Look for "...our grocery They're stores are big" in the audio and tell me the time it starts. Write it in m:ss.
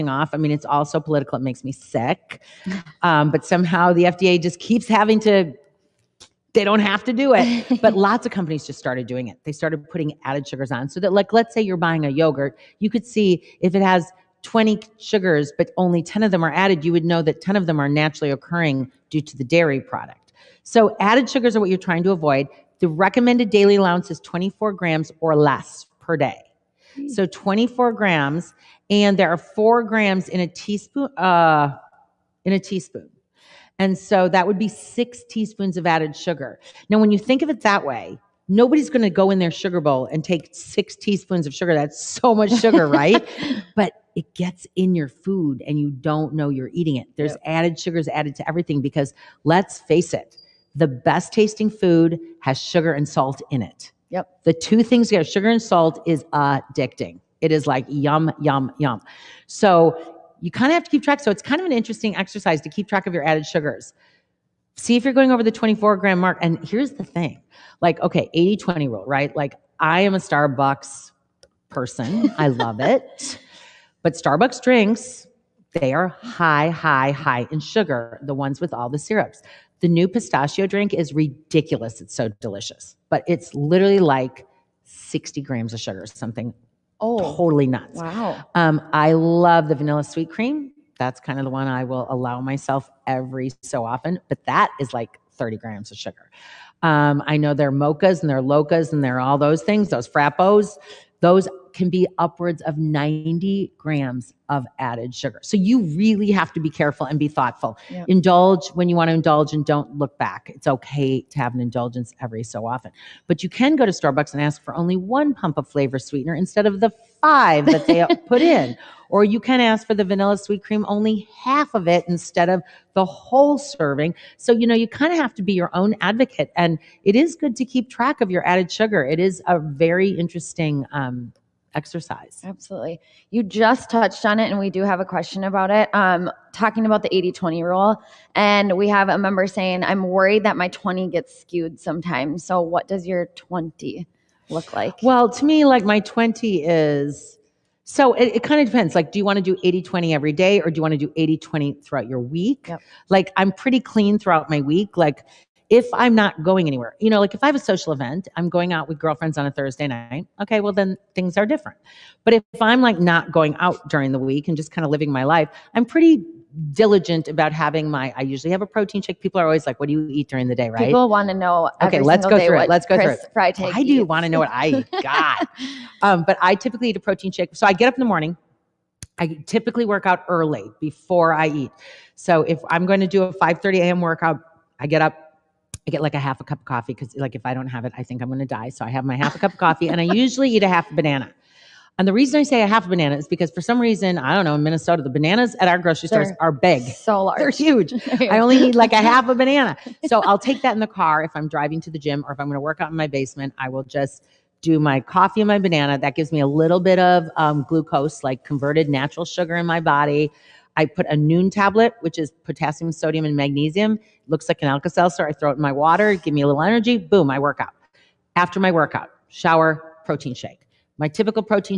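3:15.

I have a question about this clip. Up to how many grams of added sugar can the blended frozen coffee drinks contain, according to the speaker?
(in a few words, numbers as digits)
90 grams.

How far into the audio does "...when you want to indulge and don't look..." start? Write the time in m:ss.
1:48.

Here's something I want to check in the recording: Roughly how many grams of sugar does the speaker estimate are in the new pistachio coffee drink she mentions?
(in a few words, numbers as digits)
60 grams.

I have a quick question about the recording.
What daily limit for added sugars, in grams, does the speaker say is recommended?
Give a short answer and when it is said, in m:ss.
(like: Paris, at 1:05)
24 grams, at 0:24.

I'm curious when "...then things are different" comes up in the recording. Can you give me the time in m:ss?
2:40.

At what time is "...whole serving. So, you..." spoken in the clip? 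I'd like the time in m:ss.
2:03.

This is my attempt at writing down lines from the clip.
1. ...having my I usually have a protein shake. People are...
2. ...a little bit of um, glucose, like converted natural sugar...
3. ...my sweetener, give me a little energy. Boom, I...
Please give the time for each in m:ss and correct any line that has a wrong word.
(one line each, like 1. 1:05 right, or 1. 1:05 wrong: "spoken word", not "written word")
1. 2:47 right
2. 3:26 right
3. 3:35 wrong: "water", not "sweetener".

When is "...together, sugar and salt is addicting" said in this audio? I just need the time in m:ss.
0:55.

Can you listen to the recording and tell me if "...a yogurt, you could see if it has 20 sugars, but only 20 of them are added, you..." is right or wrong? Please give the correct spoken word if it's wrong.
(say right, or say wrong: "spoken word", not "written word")
wrong: "10", not "20".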